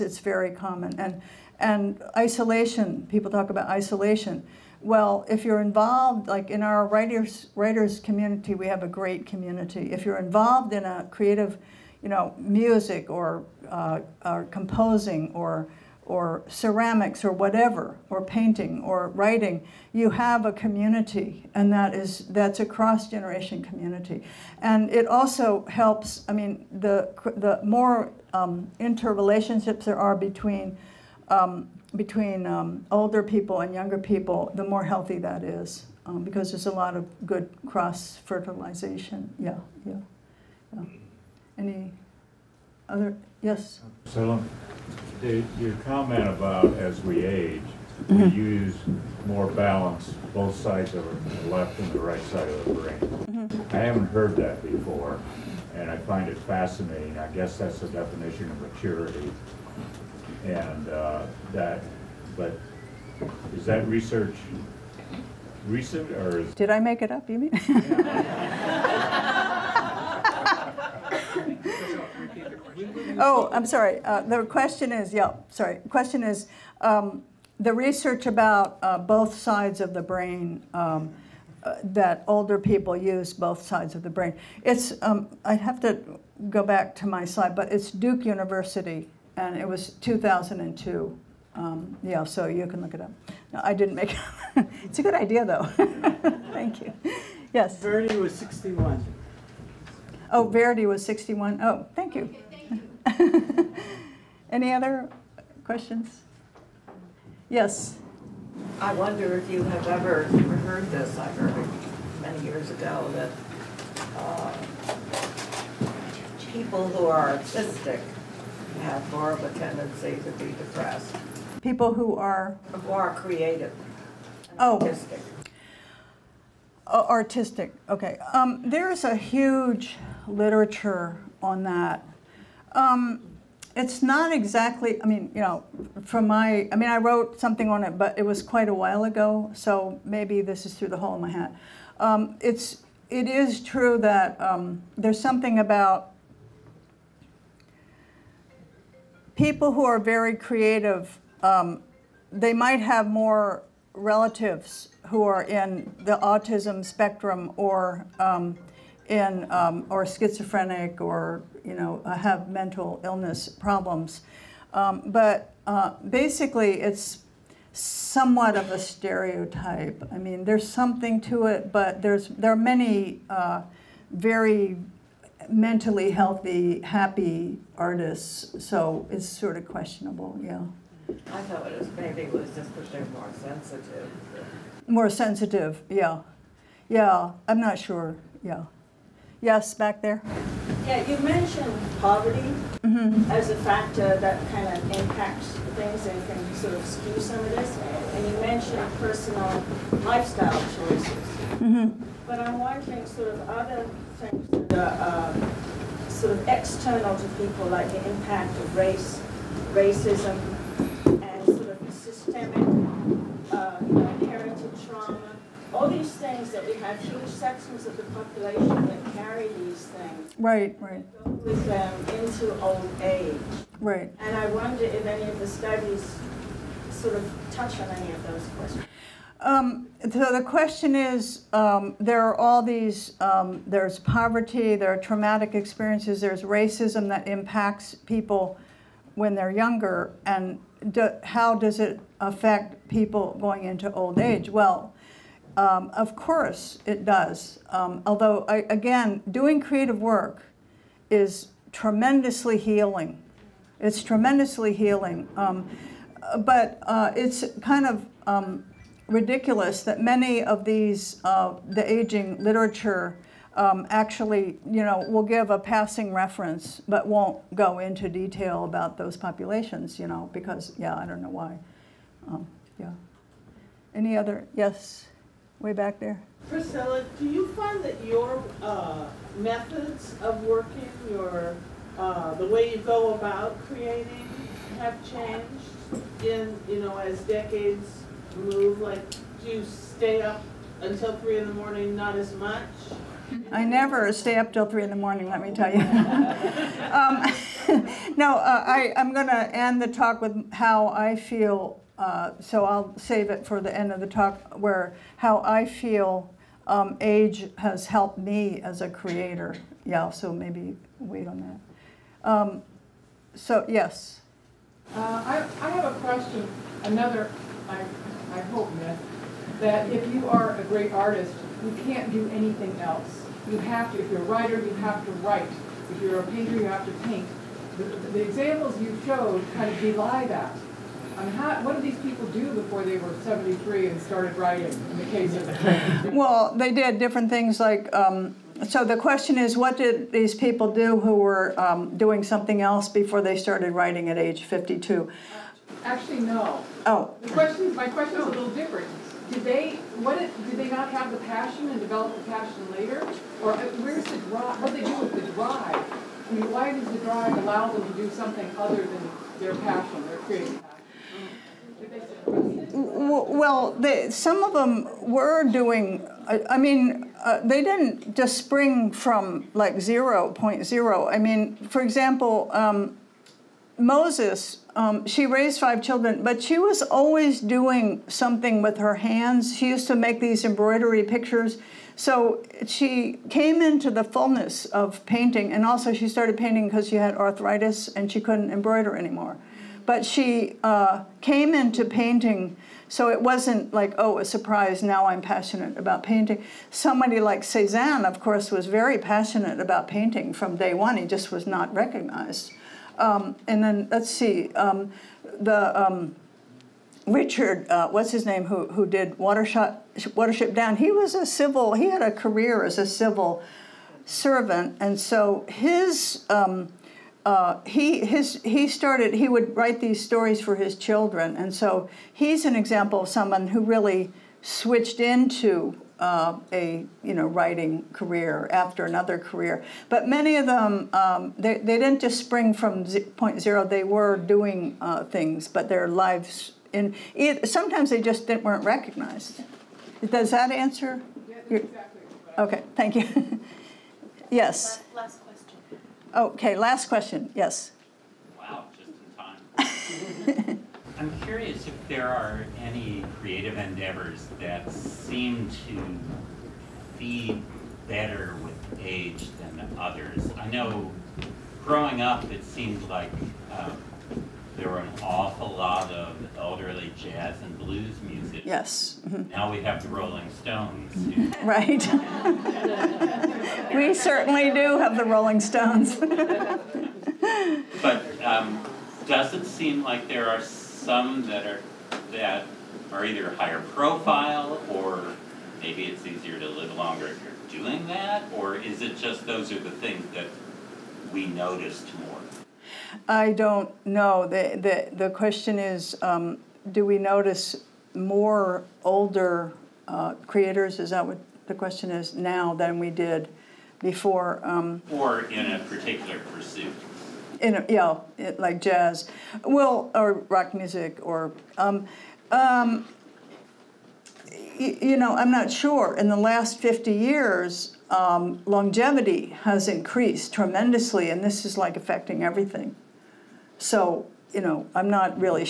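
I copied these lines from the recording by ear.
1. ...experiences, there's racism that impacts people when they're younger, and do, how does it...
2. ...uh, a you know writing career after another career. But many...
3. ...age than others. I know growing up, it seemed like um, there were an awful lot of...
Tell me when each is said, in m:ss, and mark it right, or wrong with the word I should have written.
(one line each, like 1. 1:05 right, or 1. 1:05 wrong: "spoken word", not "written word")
1. 3:55 right
2. 7:05 right
3. 7:38 right.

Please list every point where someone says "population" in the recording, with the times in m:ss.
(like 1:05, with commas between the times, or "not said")
3:38, 4:29.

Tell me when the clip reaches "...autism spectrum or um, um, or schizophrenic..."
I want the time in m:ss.
2:36.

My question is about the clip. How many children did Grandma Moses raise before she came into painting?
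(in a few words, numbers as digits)
5.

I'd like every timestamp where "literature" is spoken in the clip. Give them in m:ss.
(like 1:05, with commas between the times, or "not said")
2:10, 4:22.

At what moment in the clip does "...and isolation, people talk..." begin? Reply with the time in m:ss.
0:01.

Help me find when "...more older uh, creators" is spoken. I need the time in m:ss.
8:17.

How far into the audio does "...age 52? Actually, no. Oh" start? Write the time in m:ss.
5:44.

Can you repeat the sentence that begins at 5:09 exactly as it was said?
Yeah, so maybe wait on that.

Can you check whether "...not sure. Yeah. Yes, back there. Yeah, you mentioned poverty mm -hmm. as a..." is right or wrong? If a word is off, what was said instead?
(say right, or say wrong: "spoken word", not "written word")
right.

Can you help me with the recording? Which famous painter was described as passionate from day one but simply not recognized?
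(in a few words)
Cezanne.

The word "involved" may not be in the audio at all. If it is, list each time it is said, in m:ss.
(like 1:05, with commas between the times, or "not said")
0:05, 0:10.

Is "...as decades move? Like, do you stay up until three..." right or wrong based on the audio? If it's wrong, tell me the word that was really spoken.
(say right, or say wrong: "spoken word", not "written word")
right.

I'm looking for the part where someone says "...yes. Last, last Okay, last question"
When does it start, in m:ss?
7:24.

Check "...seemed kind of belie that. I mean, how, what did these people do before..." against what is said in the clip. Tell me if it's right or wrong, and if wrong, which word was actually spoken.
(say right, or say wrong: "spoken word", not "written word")
wrong: "showed", not "seemed".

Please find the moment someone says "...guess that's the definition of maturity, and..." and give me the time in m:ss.
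0:57.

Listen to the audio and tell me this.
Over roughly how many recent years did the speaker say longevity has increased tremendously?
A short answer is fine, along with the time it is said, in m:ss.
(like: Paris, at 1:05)
50, at 8:36.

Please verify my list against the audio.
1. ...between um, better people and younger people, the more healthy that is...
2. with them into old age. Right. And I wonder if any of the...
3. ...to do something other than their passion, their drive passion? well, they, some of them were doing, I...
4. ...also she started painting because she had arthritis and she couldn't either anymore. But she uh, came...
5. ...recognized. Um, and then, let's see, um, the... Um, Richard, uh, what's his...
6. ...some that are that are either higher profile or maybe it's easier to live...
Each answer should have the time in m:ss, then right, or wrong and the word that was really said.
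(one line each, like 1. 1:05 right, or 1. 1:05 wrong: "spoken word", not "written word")
1. 0:31 wrong: "older", not "better"
2. 3:41 right
3. 5:57 wrong: "creative", not "drive"
4. 6:25 wrong: "embroider", not "either"
5. 6:41 right
6. 8:00 right.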